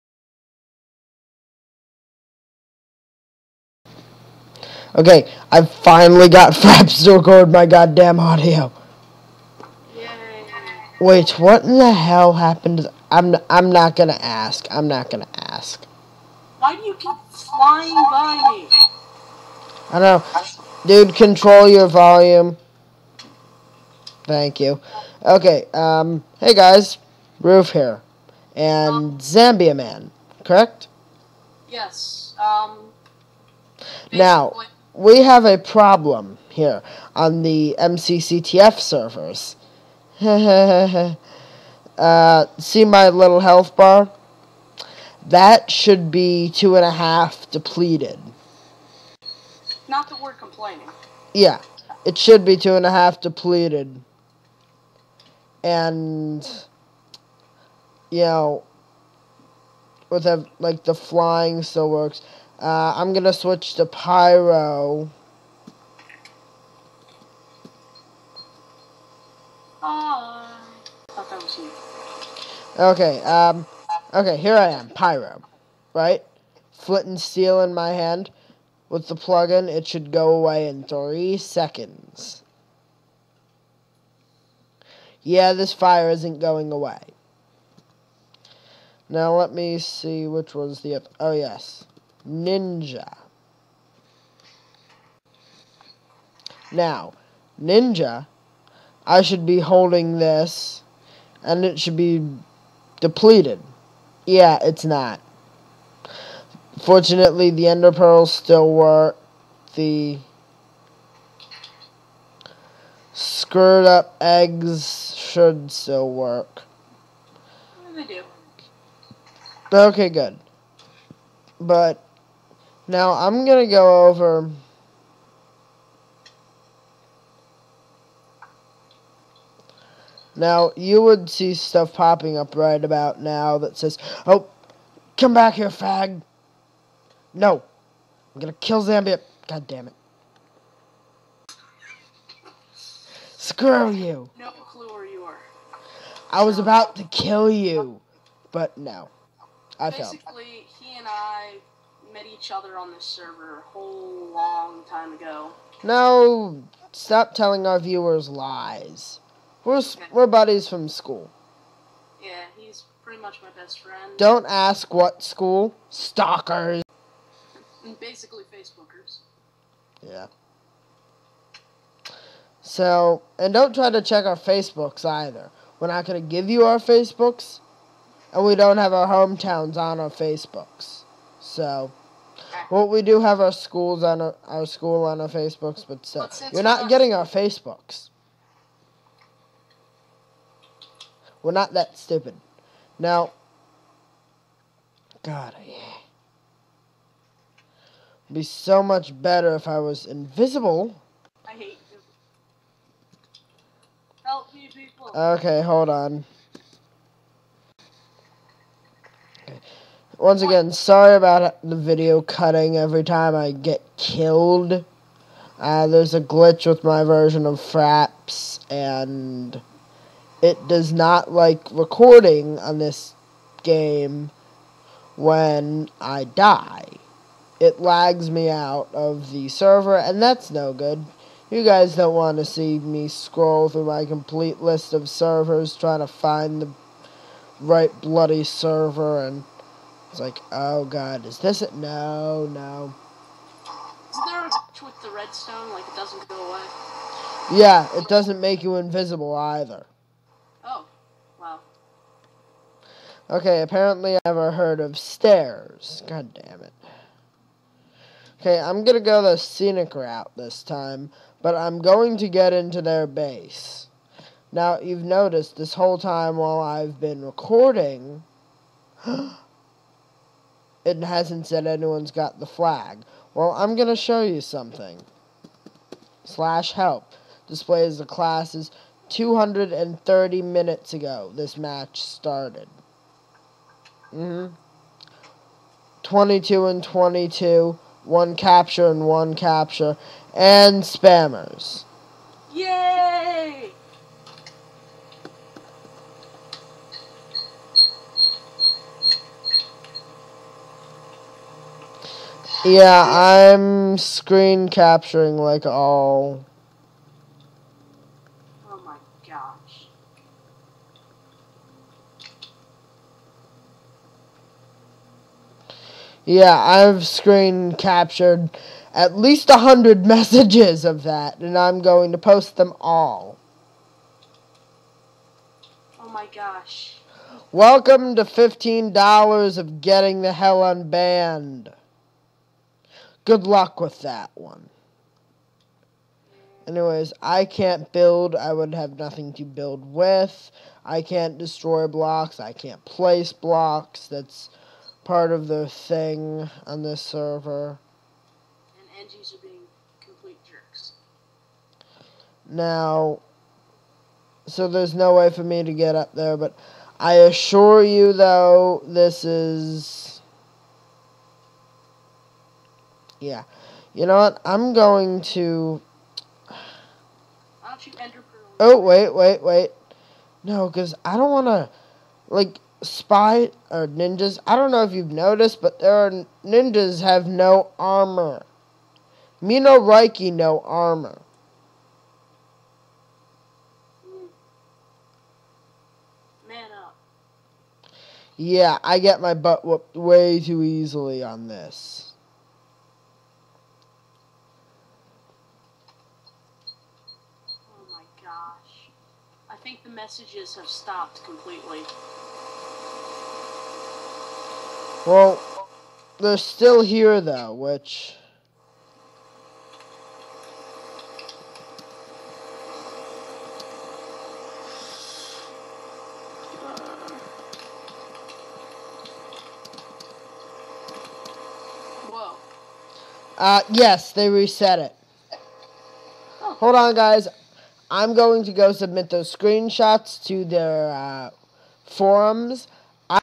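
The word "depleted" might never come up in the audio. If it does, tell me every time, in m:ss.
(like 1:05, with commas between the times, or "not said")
0:47, 0:53, 1:42.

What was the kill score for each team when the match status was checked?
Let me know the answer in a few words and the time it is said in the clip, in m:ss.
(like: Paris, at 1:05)
22 and 22, at 4:46.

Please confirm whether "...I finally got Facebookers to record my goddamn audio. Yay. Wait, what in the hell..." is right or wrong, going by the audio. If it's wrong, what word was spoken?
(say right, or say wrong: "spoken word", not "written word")
wrong: "Fraps", not "Facebookers".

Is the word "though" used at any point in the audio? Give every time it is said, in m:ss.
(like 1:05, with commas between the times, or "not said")
5:58, 6:47.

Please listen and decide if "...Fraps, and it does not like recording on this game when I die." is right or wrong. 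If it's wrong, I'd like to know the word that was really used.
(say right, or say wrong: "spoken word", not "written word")
right.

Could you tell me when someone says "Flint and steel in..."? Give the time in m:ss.
1:16.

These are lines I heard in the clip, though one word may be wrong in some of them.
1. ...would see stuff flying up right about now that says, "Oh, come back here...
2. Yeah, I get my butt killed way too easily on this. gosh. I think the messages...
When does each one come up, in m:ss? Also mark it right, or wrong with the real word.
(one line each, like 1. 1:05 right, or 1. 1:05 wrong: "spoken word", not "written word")
1. 2:11 wrong: "popping", not "flying"
2. 6:28 wrong: "whooped", not "killed".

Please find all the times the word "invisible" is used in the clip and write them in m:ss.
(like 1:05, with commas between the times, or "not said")
3:20, 4:08.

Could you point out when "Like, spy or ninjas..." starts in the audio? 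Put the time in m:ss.
6:12.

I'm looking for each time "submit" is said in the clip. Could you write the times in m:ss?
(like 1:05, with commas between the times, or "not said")
7:08.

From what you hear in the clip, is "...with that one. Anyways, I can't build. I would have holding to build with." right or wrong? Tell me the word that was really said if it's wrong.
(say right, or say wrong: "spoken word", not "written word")
wrong: "nothing", not "holding".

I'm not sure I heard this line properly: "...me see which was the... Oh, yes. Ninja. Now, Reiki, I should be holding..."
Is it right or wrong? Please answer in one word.
wrong.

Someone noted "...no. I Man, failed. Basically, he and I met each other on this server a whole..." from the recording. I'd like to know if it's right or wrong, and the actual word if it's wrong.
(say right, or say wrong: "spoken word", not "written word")
wrong: "Basically", not "Man".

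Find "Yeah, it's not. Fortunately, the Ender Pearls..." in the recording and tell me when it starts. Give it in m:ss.
1:44.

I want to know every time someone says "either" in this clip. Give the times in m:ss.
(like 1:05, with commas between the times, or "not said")
2:55, 4:09.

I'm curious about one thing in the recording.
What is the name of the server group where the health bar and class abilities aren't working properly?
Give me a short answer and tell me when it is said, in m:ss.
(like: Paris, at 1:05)
MCCTF, at 0:37.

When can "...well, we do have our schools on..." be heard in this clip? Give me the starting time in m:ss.
3:02.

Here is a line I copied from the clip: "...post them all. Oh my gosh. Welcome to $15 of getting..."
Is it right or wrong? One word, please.
right.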